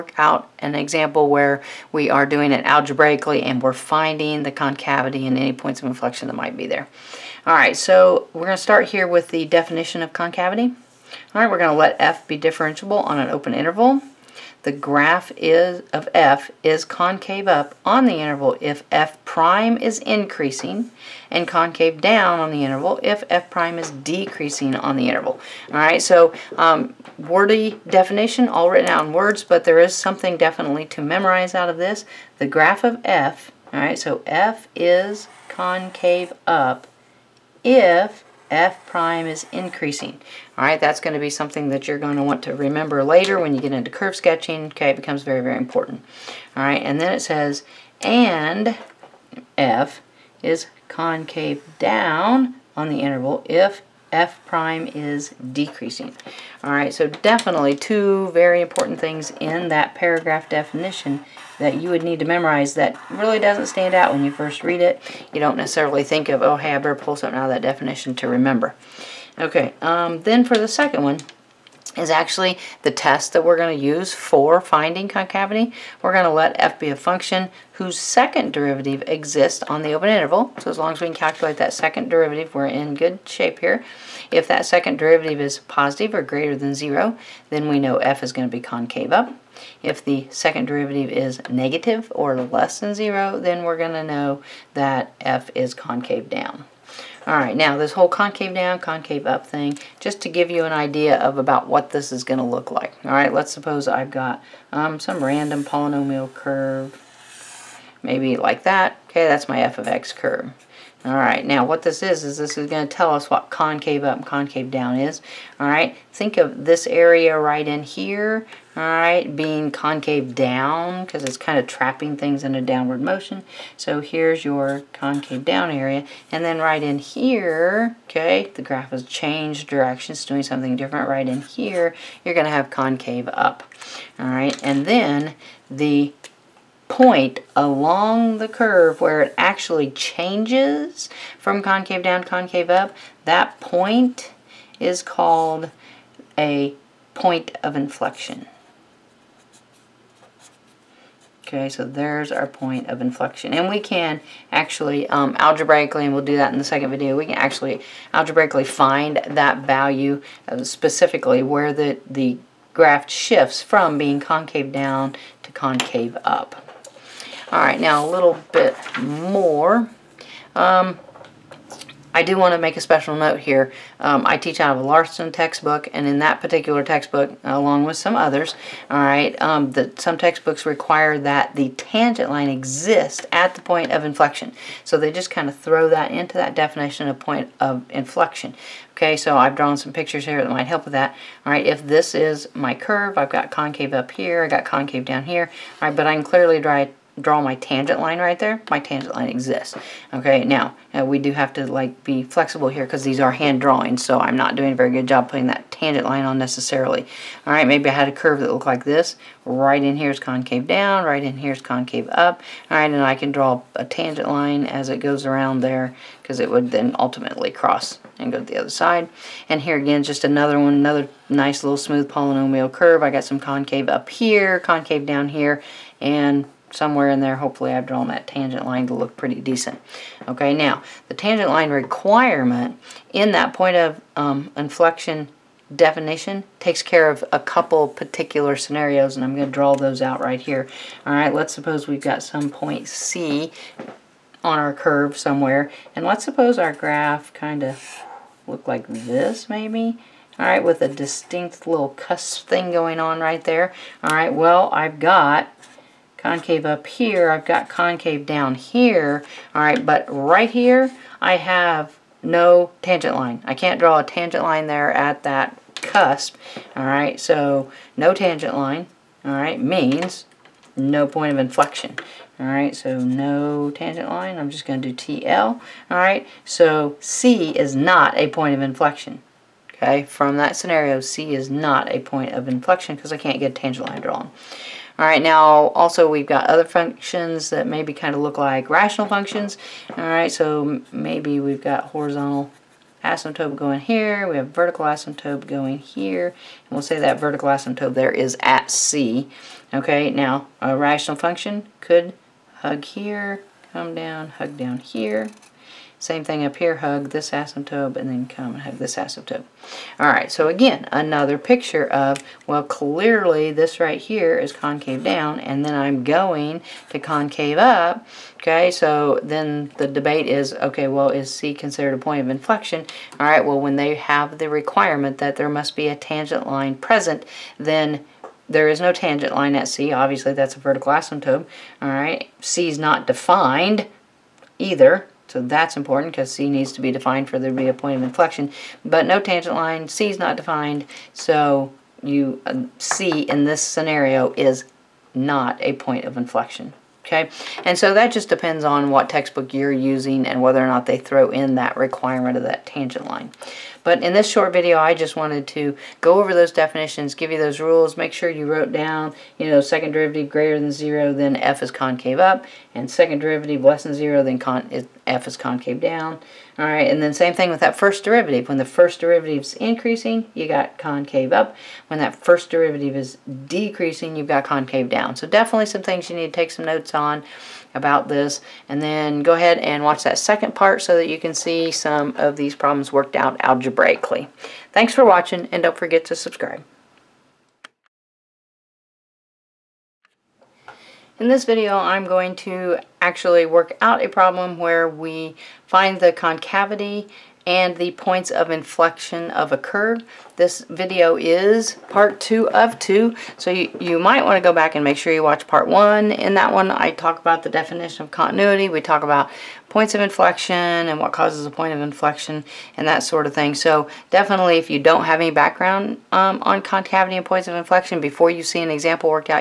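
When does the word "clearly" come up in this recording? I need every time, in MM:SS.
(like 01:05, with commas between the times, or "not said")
03:16, 05:12.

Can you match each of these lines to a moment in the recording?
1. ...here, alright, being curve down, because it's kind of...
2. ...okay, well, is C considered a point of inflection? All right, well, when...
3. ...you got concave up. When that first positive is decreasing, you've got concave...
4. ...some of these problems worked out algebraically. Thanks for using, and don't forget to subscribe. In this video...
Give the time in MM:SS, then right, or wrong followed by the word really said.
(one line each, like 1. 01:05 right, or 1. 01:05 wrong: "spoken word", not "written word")
1. 01:57 wrong: "concave", not "curve"
2. 05:20 right
3. 06:10 wrong: "derivative", not "positive"
4. 06:21 wrong: "watching", not "using".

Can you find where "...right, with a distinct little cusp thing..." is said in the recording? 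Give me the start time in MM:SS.
04:10.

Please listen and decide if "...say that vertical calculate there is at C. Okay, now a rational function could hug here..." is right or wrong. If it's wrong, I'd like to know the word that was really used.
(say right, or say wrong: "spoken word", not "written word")
wrong: "asymptote", not "calculate".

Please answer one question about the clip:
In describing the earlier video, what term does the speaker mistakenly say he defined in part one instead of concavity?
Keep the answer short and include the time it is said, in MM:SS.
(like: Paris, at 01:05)
continuity, at 06:48.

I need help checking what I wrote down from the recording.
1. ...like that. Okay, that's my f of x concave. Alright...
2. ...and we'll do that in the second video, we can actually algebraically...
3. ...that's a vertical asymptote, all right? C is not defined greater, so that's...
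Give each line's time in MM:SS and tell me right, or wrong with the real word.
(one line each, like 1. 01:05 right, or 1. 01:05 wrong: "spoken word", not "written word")
1. 01:48 wrong: "curve", not "concave"
2. 02:36 right
3. 05:30 wrong: "either", not "greater".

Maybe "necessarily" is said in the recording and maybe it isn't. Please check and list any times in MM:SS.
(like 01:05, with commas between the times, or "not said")
01:05, 03:26.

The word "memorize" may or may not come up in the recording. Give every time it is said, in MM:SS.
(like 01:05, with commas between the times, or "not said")
00:31, 01:02.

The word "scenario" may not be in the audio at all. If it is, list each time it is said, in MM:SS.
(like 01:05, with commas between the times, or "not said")
03:58, 04:40, 05:43.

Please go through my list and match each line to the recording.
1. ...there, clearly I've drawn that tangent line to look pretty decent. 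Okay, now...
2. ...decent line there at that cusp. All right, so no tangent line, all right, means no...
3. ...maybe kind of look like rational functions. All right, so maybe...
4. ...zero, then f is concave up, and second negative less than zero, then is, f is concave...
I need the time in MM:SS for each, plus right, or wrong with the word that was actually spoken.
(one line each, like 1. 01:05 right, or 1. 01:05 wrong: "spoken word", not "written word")
1. 03:47 wrong: "hopefully", not "clearly"
2. 04:24 wrong: "tangent", not "decent"
3. 04:47 right
4. 06:00 wrong: "derivative", not "negative".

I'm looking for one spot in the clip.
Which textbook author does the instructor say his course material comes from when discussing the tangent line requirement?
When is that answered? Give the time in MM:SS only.
02:54.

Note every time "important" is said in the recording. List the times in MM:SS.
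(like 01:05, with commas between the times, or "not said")
00:45, 00:58, 05:35.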